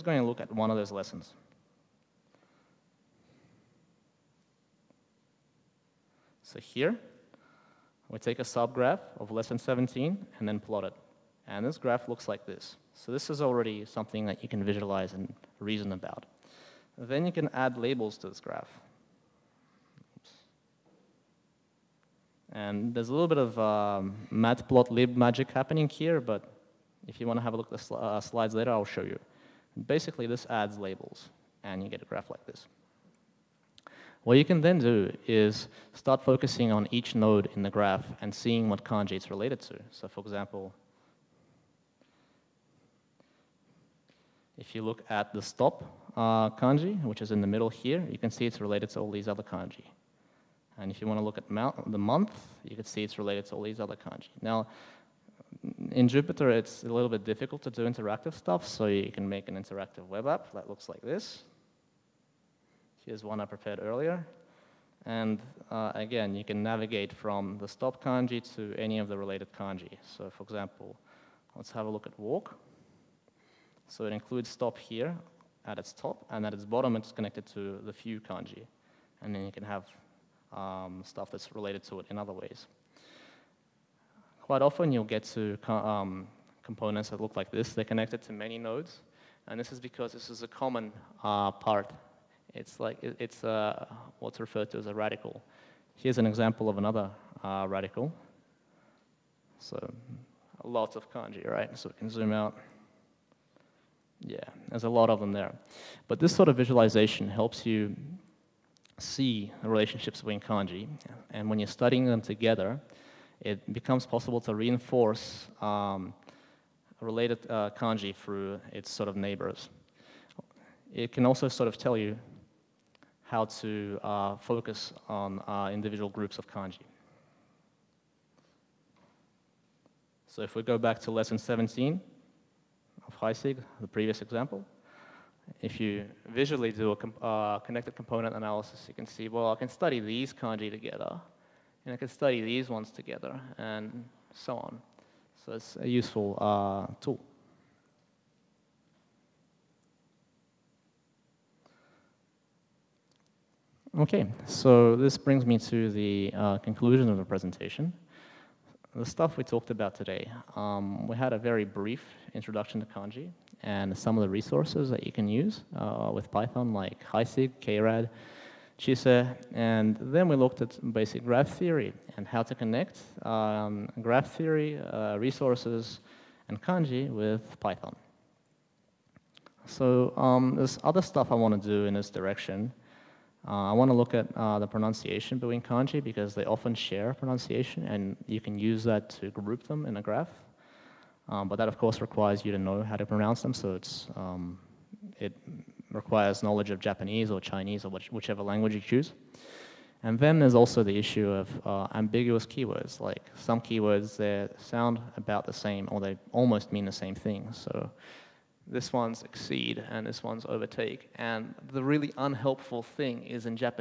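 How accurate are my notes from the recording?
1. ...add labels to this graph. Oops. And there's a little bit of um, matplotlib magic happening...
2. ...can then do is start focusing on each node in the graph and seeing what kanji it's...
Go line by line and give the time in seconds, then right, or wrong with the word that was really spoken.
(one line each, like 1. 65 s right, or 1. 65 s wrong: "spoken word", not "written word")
1. 17 s right
2. 34 s right.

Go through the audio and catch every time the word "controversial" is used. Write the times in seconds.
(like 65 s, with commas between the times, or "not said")
not said.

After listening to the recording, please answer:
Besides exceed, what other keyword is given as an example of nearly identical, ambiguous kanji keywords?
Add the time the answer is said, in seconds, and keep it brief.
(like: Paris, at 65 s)
overtake, at 210 s.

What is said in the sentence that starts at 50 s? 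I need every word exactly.
And if you want to look at the month, you can see it's related to all these other kanji.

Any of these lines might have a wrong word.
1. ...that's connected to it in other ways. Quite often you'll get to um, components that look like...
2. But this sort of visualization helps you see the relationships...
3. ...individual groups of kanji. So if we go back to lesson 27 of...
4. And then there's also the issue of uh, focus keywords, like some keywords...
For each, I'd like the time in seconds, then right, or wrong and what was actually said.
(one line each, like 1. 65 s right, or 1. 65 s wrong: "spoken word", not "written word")
1. 81 s wrong: "related", not "connected"
2. 106 s right
3. 125 s wrong: "17", not "27"
4. 200 s wrong: "ambiguous", not "focus".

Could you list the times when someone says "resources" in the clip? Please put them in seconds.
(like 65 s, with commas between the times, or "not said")
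164 s, 175 s.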